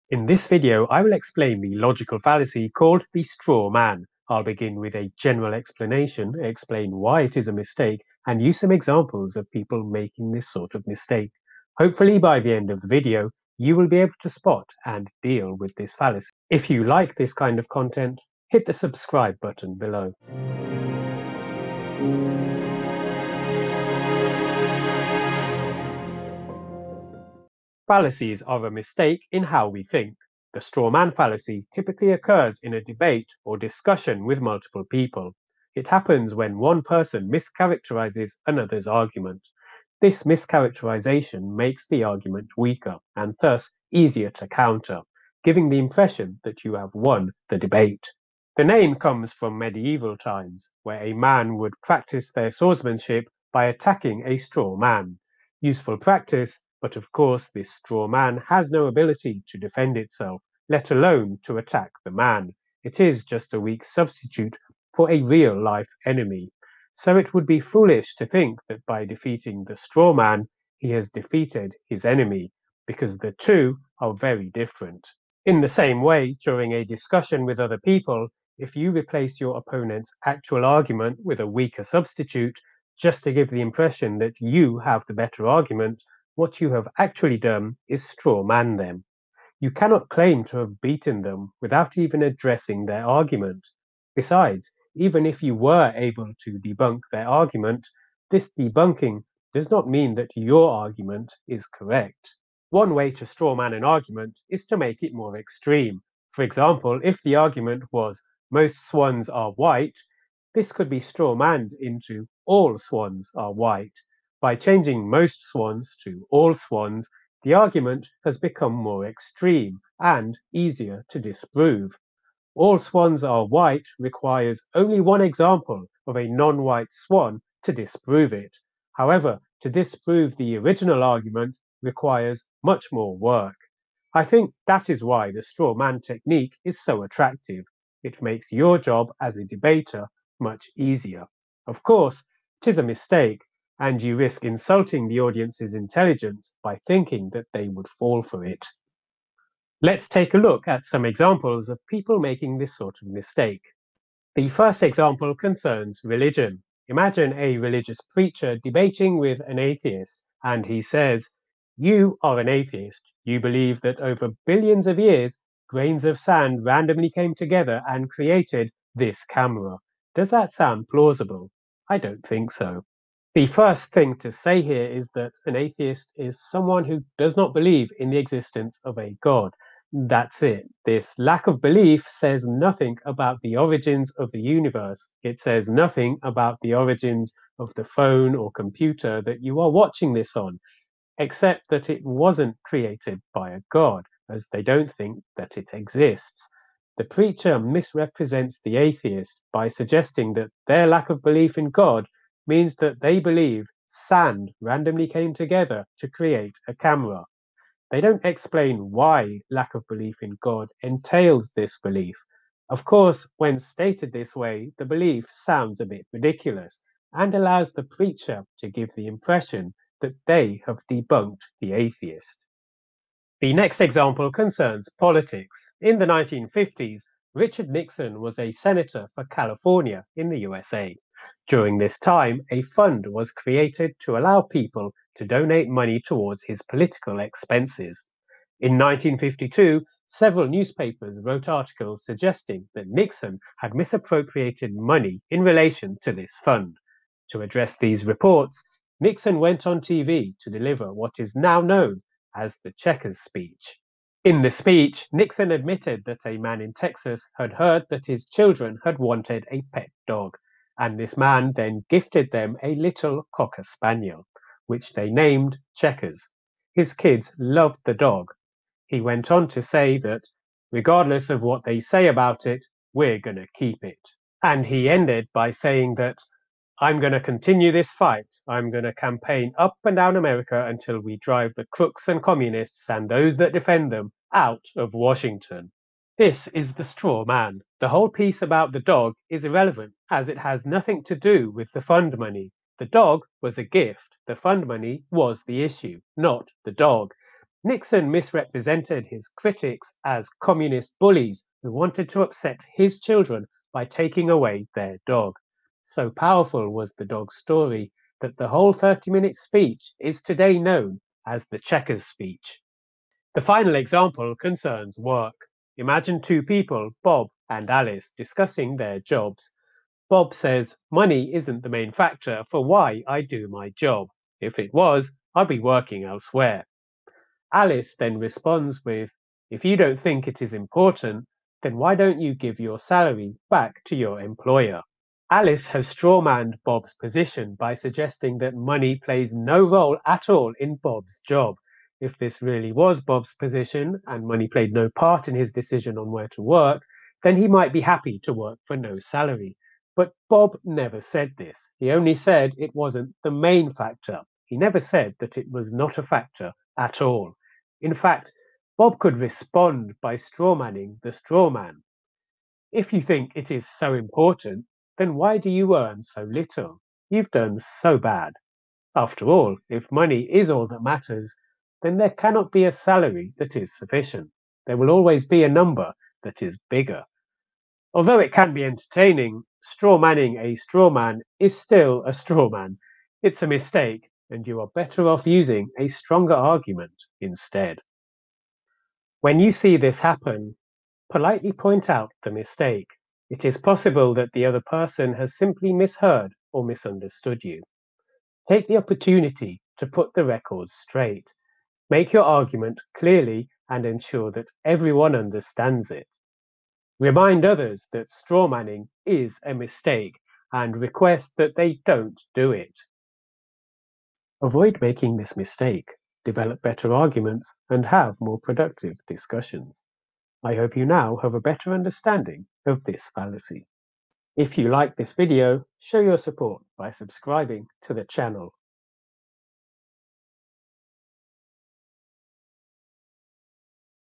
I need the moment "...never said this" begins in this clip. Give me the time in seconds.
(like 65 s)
350 s.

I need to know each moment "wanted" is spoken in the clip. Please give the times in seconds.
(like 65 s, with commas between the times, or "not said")
258 s, 301 s.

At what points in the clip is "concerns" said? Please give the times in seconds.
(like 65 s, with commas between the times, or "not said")
155 s, 224 s, 314 s.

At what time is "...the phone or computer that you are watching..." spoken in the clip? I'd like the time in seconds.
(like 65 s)
187 s.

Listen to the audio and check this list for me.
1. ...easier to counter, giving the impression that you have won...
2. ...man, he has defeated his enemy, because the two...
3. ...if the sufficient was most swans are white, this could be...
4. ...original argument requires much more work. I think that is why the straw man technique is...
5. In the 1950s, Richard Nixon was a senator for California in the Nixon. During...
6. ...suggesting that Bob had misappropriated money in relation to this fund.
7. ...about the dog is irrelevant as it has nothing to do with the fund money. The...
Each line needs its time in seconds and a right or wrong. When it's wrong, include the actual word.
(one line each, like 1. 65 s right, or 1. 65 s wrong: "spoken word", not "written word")
1. 43 s right
2. 70 s right
3. 107 s wrong: "argument", not "sufficient"
4. 130 s right
5. 225 s wrong: "USA", not "Nixon"
6. 242 s wrong: "Nixon", not "Bob"
7. 288 s right.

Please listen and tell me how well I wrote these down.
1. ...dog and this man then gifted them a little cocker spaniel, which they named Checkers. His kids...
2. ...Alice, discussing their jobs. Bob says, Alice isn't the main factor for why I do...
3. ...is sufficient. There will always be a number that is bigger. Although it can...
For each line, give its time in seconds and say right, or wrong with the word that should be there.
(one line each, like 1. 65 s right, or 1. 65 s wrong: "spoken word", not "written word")
1. 260 s right
2. 317 s wrong: "Money", not "Alice"
3. 373 s right.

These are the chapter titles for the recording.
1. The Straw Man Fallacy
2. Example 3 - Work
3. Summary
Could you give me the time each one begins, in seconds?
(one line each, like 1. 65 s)
1. 28 s
2. 313 s
3. 389 s.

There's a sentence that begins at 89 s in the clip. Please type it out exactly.
You cannot claim to have beaten them without even addressing their argument.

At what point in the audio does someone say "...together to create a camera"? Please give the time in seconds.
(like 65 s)
205 s.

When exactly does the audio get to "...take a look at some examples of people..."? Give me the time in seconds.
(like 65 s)
150 s.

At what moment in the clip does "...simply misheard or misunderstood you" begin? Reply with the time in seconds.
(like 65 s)
395 s.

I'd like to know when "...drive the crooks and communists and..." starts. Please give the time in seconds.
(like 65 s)
281 s.